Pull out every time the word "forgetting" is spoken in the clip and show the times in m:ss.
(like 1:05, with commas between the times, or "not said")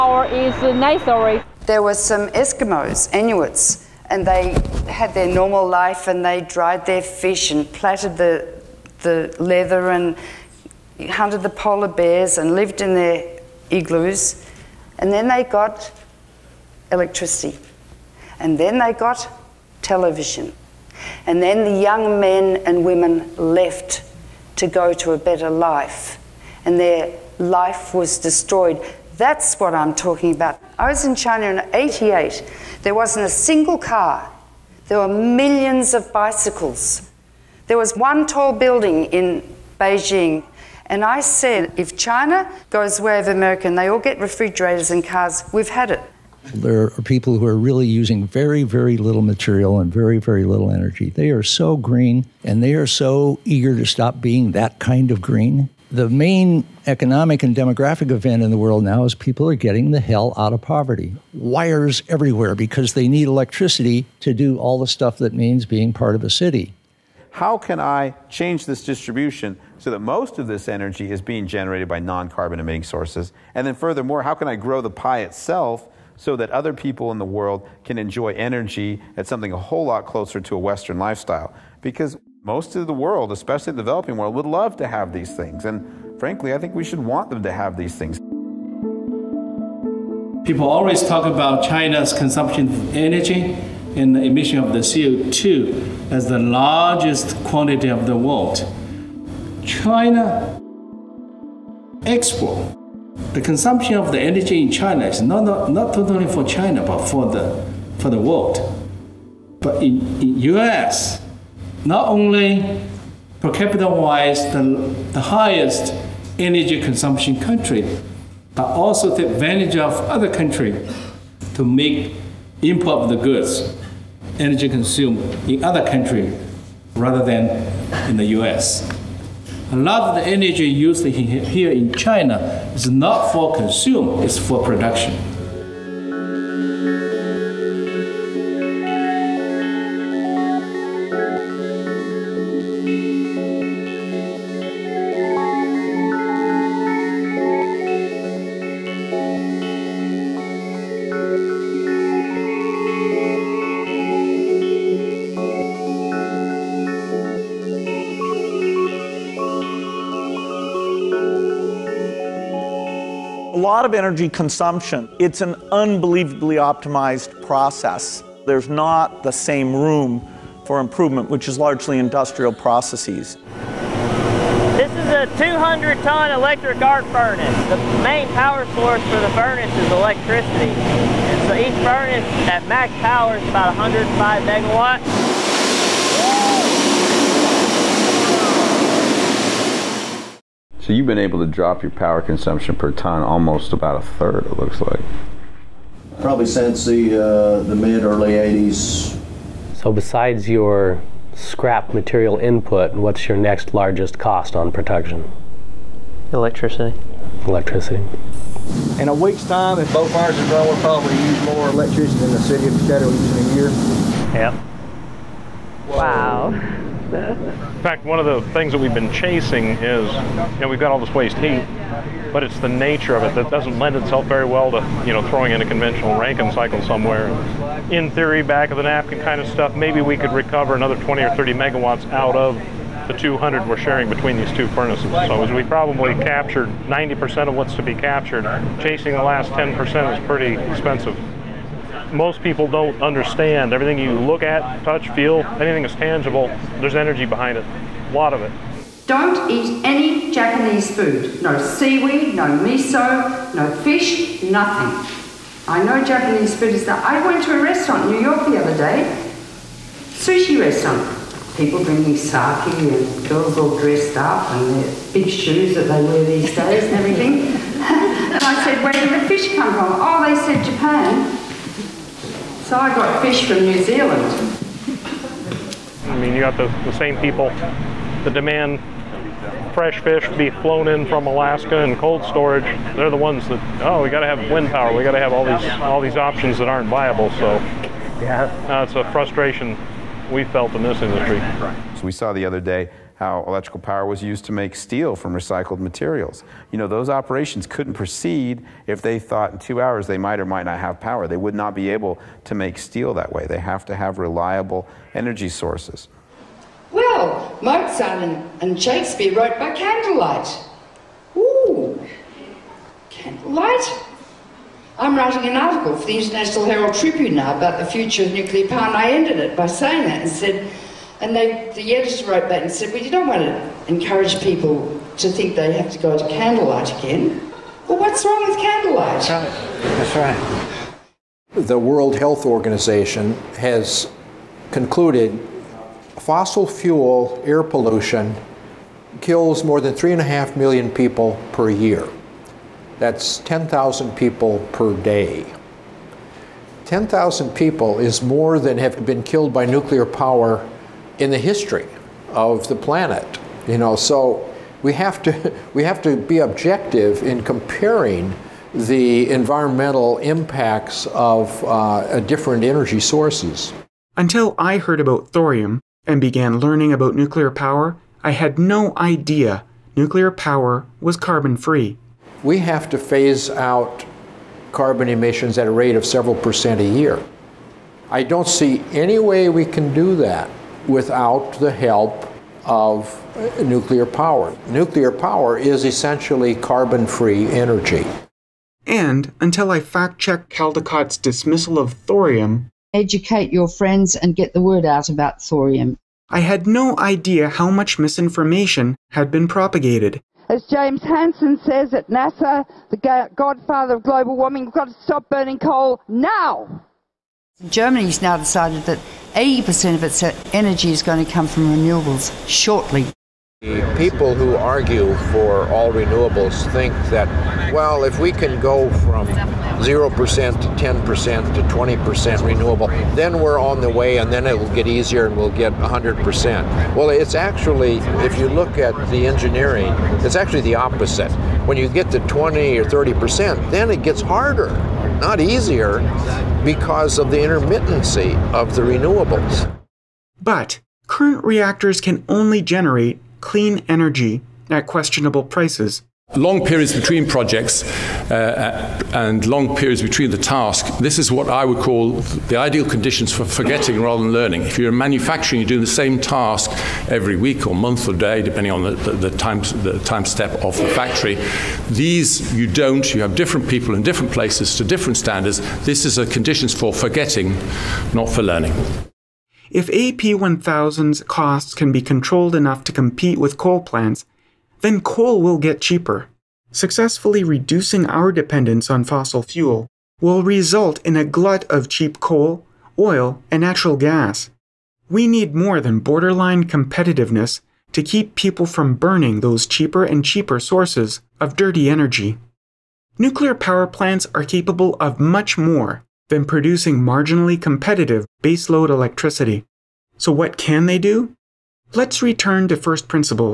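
7:33, 7:46.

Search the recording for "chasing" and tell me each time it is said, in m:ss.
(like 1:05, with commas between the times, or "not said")
3:39, 3:58.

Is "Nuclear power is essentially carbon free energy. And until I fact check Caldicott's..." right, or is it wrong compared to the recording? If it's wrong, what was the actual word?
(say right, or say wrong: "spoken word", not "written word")
right.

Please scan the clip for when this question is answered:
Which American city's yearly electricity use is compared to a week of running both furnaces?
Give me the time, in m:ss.
3:32.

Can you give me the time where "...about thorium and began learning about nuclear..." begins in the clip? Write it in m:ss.
6:04.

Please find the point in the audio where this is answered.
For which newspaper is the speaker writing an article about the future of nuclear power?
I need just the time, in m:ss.
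5:16.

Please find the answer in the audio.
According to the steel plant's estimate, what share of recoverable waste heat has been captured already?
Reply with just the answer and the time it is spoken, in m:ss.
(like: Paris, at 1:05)
90%, at 3:56.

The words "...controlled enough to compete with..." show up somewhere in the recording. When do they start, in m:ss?
7:52.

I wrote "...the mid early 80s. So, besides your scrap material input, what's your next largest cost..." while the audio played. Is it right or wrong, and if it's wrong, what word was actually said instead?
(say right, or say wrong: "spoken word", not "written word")
right.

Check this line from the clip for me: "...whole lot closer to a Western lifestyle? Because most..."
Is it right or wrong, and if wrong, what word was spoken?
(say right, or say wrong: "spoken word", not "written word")
right.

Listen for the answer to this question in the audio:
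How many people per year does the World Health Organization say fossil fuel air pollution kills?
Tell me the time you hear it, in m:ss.
5:39.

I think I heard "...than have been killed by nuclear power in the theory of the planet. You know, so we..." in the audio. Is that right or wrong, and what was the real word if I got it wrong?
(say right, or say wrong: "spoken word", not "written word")
wrong: "history", not "theory".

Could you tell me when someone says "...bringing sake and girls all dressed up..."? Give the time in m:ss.
4:21.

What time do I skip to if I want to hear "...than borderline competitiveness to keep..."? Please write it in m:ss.
8:05.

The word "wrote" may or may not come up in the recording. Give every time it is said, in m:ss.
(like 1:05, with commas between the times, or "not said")
5:09, 5:22.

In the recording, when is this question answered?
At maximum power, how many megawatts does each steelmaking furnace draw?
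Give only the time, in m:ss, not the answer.
3:03.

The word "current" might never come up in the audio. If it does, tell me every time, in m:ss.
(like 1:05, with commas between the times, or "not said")
7:21.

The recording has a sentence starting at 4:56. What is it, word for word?
You know, those operations couldn't proceed if they thought in two hours they might or might not have power.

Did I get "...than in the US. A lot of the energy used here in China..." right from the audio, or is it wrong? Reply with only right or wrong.
right.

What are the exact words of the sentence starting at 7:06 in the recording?
Well, it's actually, if you look at the engineering, it's actually the opposite.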